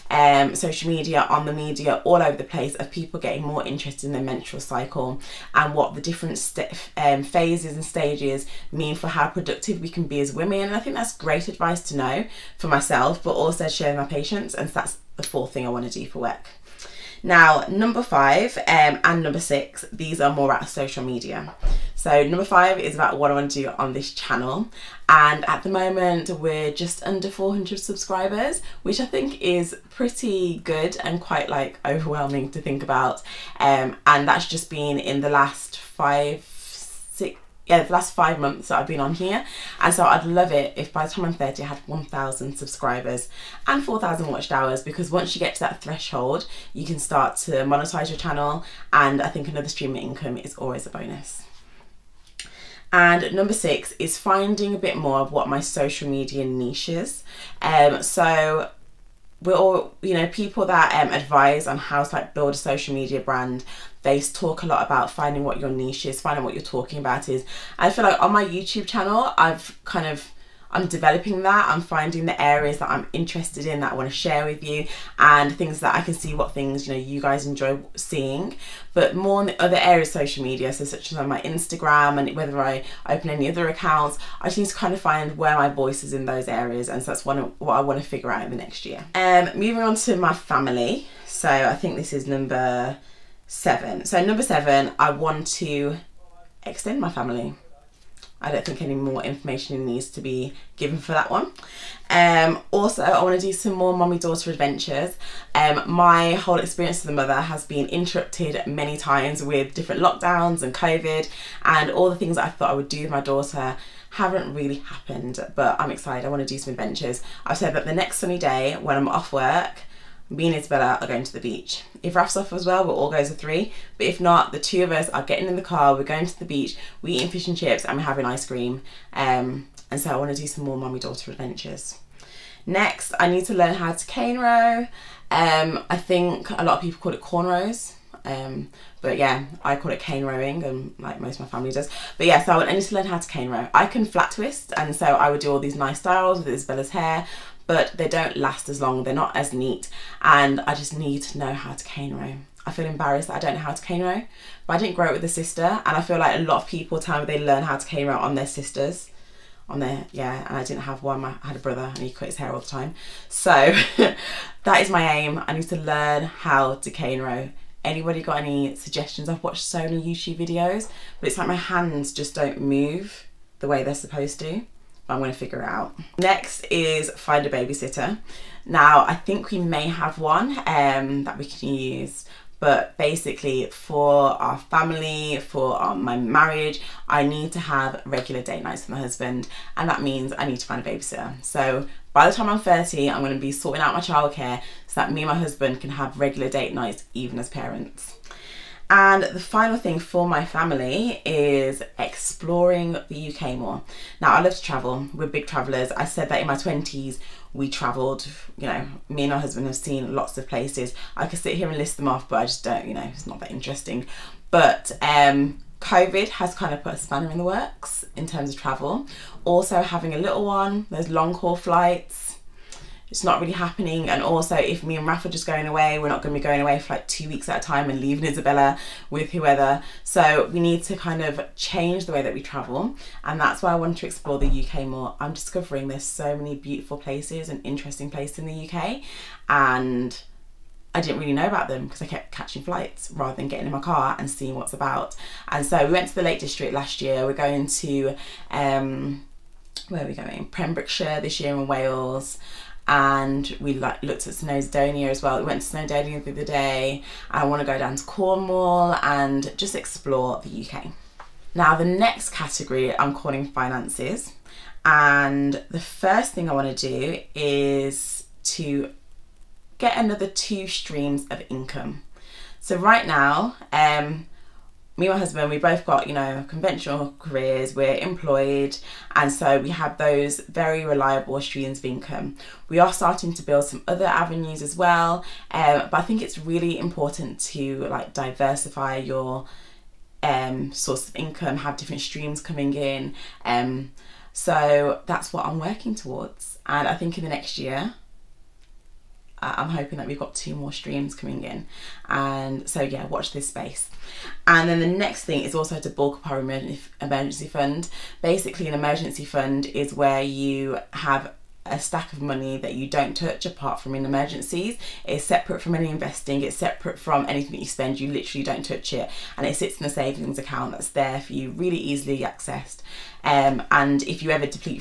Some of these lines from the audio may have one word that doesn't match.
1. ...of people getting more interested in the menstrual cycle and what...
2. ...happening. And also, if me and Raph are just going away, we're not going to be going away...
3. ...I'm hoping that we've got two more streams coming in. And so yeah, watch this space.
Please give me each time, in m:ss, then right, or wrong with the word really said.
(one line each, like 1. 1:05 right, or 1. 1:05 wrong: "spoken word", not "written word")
1. 0:02 right
2. 3:43 right
3. 4:59 right.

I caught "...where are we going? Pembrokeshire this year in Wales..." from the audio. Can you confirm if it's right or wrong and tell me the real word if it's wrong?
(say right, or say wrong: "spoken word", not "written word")
right.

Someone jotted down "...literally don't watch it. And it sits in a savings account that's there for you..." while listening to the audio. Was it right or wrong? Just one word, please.
wrong.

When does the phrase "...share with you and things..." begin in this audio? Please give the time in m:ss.
1:14.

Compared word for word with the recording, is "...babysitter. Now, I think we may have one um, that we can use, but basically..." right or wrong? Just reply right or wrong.
right.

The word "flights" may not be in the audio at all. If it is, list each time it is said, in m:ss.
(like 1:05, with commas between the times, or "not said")
3:41, 4:02.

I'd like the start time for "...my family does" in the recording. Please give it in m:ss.
2:21.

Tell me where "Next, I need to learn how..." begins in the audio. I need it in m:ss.
2:12.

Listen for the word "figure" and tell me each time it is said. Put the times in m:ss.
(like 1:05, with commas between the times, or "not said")
1:28, 2:55.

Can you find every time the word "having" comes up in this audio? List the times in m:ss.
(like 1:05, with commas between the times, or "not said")
2:08, 3:39.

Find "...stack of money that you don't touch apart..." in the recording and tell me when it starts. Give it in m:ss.
5:11.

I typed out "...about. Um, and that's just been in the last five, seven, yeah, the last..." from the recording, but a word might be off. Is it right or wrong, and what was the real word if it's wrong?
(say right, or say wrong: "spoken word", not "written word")
wrong: "six", not "seven".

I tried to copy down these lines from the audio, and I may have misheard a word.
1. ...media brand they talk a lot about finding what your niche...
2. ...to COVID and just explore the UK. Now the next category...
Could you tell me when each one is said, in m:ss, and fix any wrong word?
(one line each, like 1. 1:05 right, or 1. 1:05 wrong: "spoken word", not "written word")
1. 1:02 right
2. 4:17 wrong: "Cornwall", not "COVID".